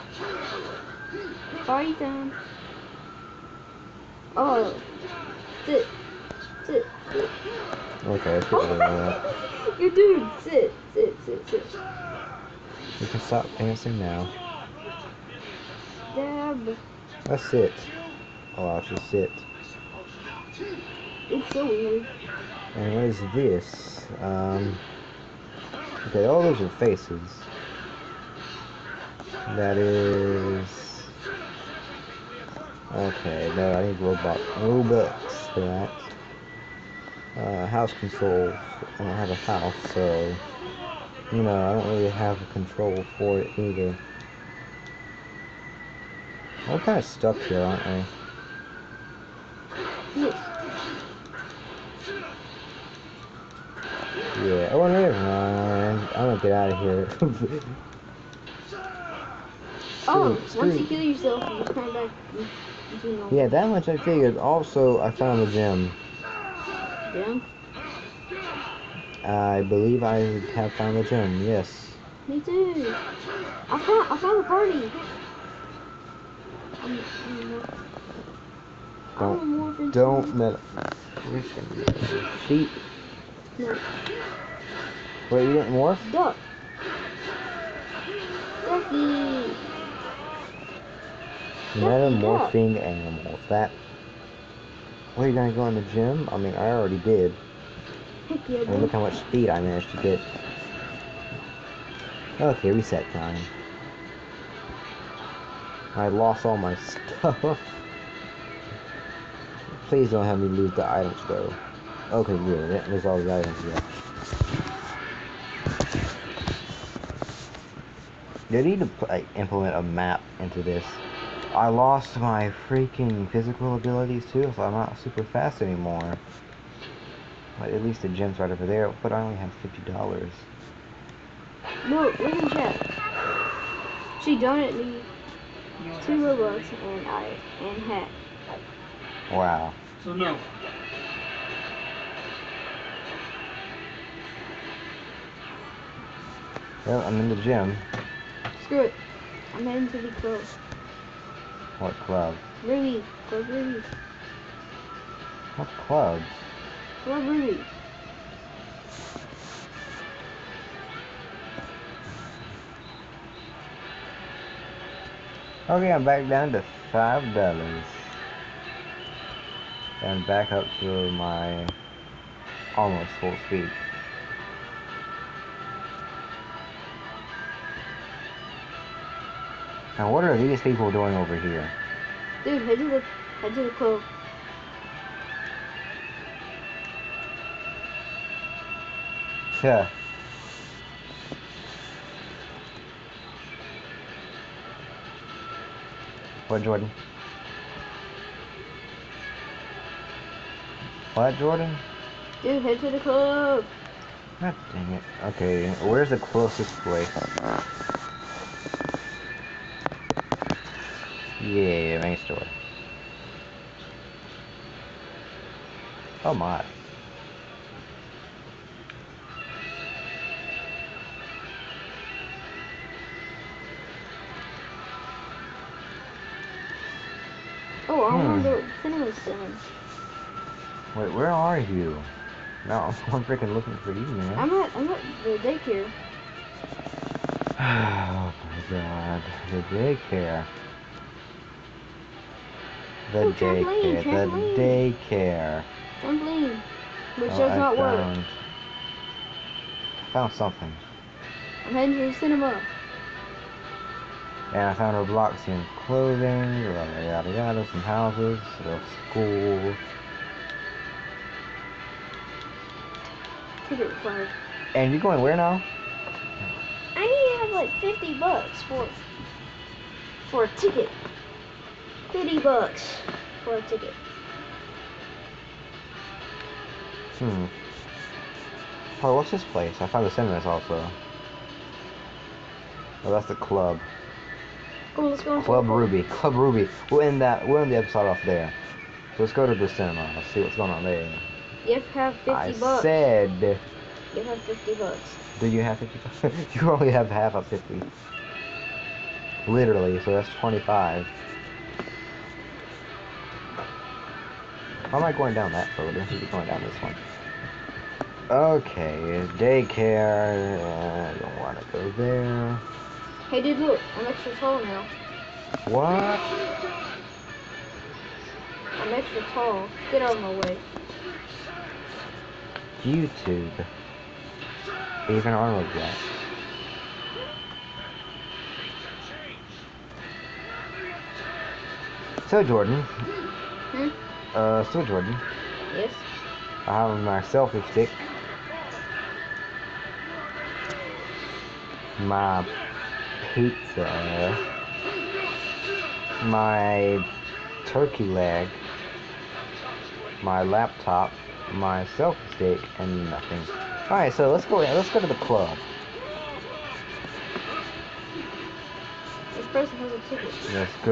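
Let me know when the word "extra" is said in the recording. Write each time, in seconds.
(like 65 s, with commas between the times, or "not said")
314 s, 318 s.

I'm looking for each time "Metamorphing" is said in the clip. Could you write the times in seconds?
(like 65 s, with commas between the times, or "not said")
91 s.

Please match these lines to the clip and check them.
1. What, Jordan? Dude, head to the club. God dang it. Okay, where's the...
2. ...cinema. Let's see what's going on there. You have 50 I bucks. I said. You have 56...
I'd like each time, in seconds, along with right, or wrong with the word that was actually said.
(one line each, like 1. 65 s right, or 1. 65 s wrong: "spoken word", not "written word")
1. 201 s right
2. 289 s wrong: "50", not "56".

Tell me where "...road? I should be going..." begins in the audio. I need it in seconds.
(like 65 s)
305 s.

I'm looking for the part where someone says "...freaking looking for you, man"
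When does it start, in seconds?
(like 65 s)
233 s.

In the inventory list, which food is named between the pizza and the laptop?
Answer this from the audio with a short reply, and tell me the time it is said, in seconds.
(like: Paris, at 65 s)
turkey leg, at 347 s.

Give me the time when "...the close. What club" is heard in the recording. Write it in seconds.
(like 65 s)
150 s.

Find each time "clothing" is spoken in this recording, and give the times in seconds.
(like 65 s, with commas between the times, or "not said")
255 s.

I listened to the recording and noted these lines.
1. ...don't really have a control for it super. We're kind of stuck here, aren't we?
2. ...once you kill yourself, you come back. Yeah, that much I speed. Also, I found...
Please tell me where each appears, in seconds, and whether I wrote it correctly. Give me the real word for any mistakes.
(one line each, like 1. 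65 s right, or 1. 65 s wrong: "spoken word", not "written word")
1. 41 s wrong: "either", not "super"
2. 60 s wrong: "figured", not "speed".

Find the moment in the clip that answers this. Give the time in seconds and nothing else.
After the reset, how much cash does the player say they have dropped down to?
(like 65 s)
166 s.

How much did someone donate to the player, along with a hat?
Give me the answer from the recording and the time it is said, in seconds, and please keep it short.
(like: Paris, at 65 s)
2 Robux, at 136 s.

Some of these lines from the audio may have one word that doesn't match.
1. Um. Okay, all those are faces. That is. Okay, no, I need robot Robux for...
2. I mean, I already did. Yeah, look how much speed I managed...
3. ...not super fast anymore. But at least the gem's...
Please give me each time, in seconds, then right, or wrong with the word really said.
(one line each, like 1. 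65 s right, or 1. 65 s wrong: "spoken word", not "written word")
1. 24 s right
2. 96 s right
3. 124 s right.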